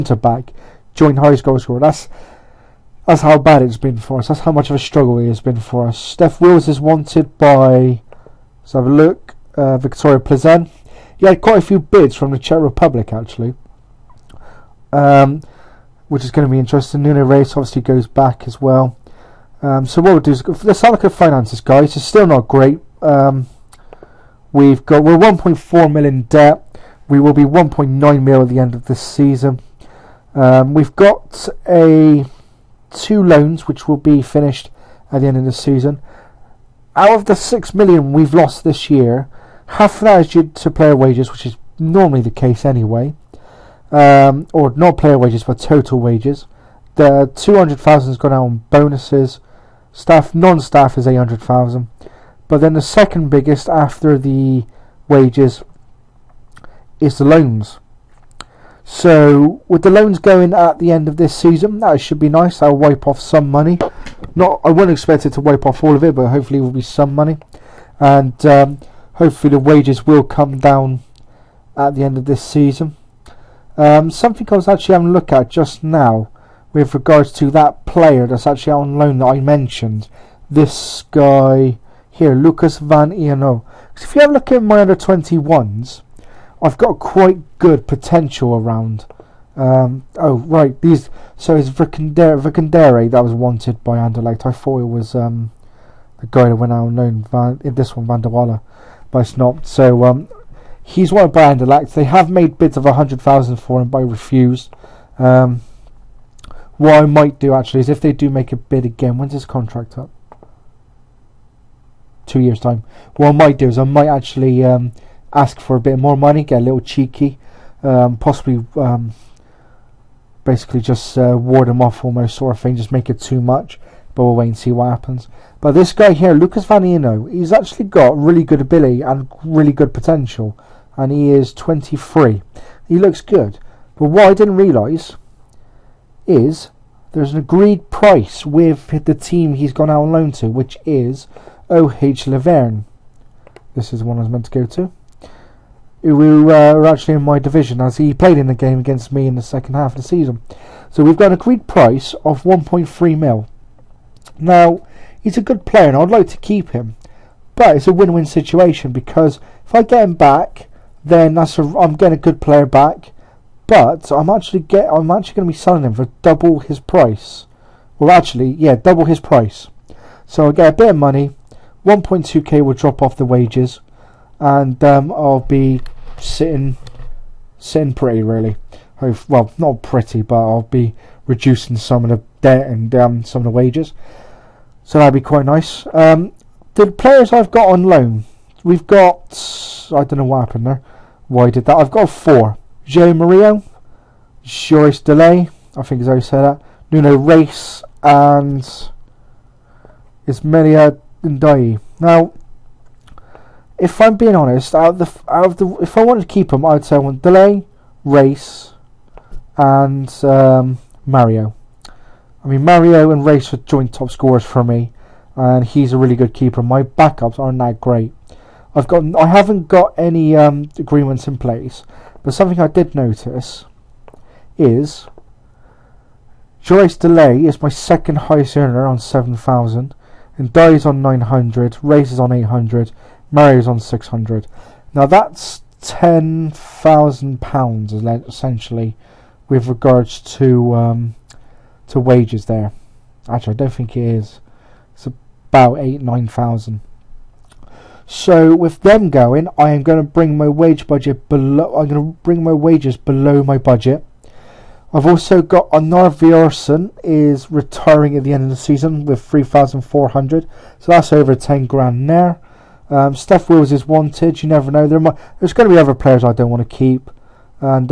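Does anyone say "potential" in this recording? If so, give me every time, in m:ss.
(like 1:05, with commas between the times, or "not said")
1:27, 2:09.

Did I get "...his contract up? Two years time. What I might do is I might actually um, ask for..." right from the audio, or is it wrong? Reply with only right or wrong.
right.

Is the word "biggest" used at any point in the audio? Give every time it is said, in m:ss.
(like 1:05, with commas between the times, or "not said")
0:53.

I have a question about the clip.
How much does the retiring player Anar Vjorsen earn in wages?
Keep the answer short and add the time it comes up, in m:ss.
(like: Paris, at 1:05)
3,400, at 4:19.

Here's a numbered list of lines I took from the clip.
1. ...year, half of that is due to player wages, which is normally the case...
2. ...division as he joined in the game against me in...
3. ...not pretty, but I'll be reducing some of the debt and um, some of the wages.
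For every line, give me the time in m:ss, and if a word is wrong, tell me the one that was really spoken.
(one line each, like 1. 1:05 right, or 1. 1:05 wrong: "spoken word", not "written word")
1. 0:38 right
2. 2:27 wrong: "played", not "joined"
3. 2:59 right.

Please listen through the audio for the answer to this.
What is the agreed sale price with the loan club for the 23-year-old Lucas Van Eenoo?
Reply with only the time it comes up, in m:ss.
2:32.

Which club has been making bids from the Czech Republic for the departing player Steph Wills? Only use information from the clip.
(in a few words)
Viktoria Plzeň.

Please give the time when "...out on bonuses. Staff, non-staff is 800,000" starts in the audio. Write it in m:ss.
0:48.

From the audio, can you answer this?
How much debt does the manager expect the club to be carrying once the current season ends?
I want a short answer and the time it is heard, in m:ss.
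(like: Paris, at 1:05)
1.9 million, at 0:27.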